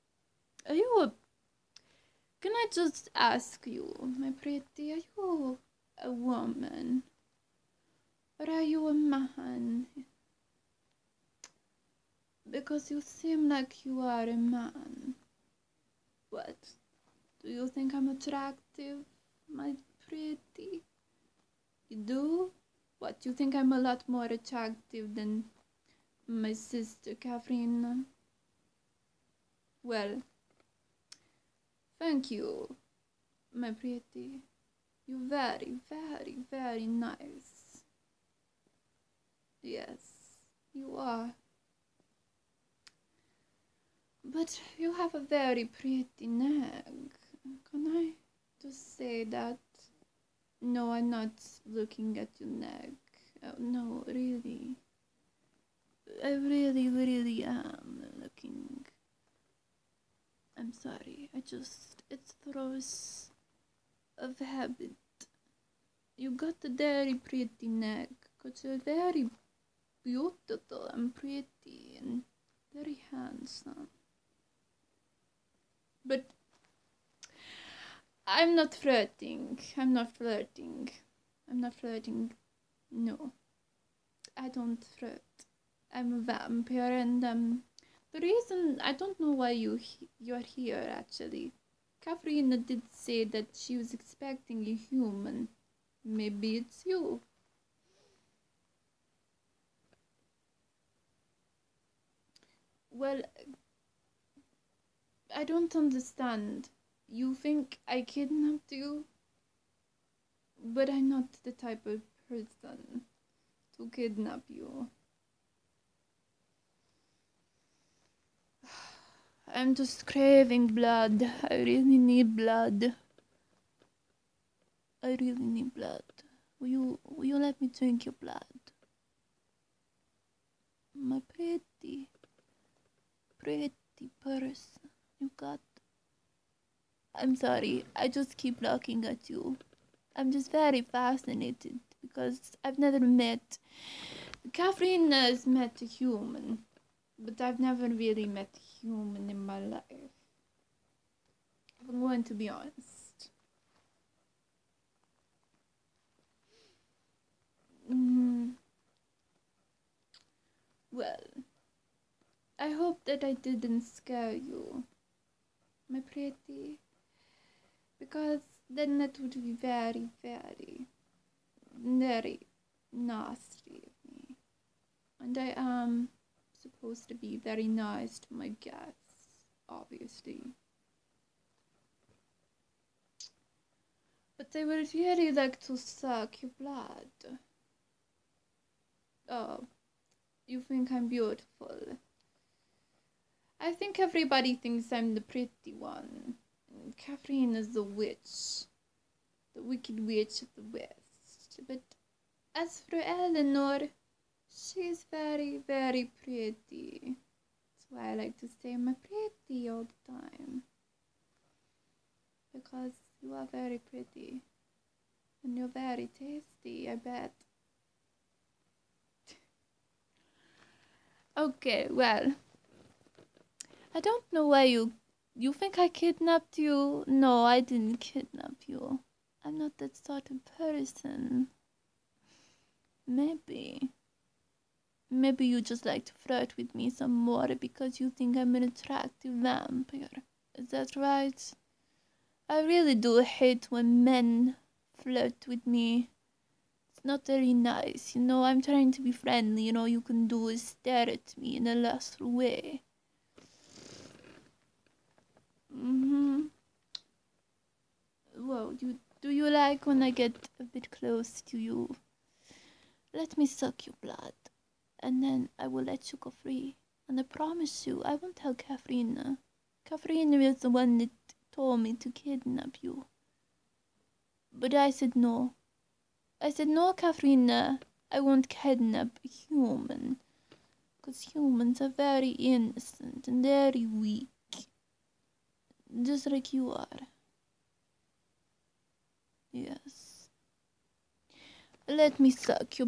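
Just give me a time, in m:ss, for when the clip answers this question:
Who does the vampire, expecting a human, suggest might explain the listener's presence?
1:32.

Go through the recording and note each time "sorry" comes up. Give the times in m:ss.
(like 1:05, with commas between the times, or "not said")
1:00, 2:17.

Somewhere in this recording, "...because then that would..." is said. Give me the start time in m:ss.
2:47.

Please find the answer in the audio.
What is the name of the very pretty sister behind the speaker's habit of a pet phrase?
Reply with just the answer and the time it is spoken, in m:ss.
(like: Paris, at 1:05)
Eleanor, at 3:23.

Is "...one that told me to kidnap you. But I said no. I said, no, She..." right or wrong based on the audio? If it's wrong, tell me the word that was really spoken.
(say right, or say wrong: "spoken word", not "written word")
wrong: "Catherine", not "She".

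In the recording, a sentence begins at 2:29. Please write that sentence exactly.
If I'm going to be honest.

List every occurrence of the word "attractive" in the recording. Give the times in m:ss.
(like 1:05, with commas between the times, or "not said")
0:18, 0:24, 3:58.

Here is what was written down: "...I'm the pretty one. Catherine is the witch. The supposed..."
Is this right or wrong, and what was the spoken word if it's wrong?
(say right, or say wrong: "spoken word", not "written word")
wrong: "wicked", not "supposed".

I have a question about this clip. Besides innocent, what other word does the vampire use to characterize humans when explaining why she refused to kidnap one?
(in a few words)
weak.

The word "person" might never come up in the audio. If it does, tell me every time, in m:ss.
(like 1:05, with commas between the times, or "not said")
1:52, 2:14, 3:50.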